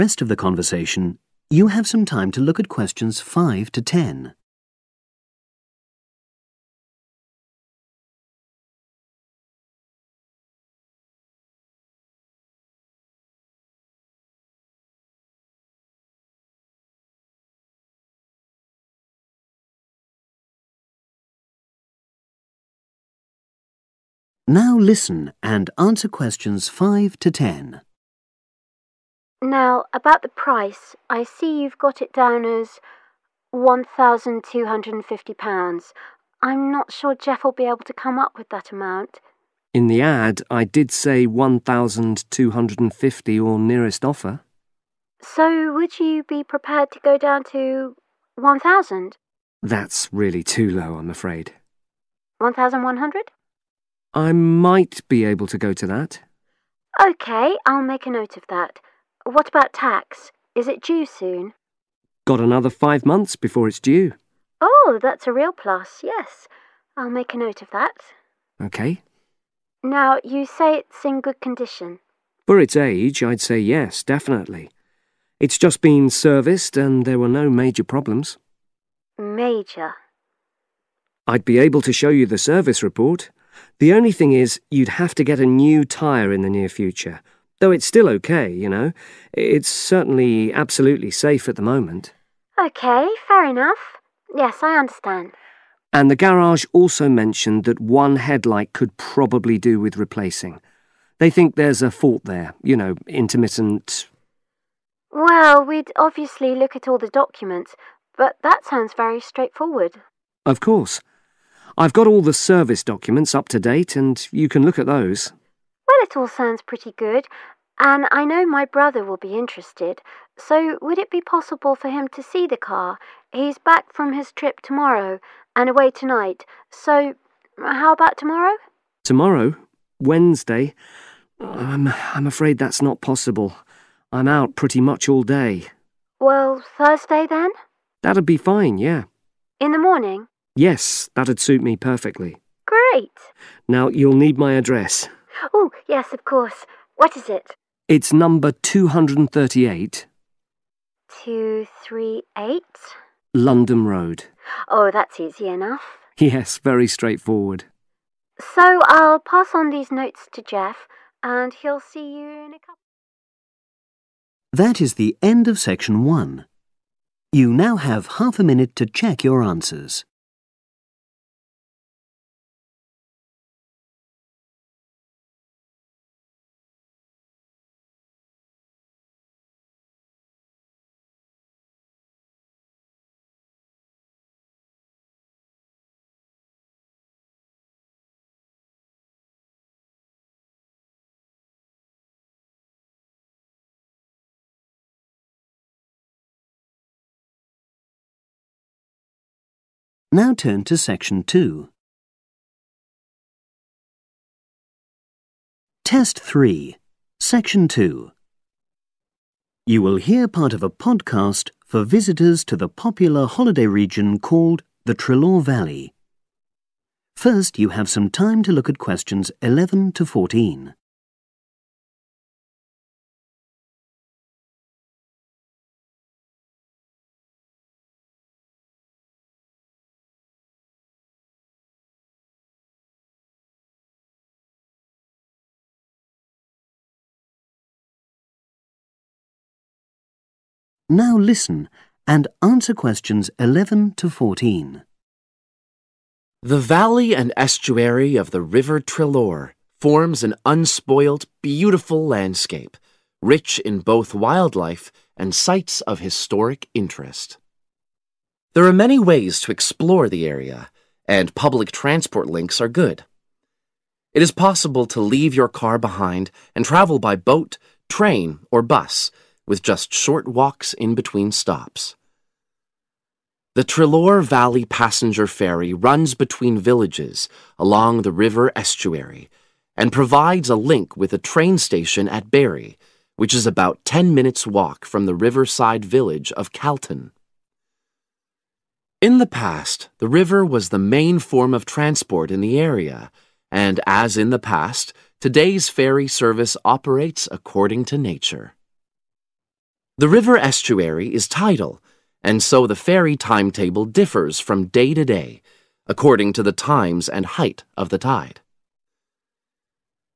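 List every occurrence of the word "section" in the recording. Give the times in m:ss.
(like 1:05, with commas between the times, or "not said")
2:45, 3:20, 3:27.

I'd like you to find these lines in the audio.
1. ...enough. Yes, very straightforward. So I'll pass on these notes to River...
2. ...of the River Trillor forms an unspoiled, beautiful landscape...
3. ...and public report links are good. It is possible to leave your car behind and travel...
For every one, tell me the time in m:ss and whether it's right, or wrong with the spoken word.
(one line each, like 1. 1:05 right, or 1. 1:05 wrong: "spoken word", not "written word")
1. 2:35 wrong: "Jeff", not "River"
2. 4:08 right
3. 4:21 wrong: "transport", not "report".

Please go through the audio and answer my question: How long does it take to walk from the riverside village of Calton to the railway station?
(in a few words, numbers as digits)
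10 minutes.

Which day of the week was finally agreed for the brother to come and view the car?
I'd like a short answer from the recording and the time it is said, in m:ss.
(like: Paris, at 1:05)
Thursday, at 2:16.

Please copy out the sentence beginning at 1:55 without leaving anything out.
Well, it all sounds pretty good, and I know my brother will be interested.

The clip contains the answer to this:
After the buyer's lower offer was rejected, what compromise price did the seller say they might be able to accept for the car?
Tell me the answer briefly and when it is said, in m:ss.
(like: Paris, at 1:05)
£1,100, at 0:52.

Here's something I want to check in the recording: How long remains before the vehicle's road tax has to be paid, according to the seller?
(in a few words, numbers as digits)
5 months.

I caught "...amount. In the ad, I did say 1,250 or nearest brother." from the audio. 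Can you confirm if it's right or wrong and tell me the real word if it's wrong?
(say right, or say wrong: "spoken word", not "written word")
wrong: "offer", not "brother".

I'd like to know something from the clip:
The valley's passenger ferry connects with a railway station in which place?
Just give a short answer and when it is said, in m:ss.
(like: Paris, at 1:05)
Barry, at 4:42.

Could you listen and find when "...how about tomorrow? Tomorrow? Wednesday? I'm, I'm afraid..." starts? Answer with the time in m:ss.
2:07.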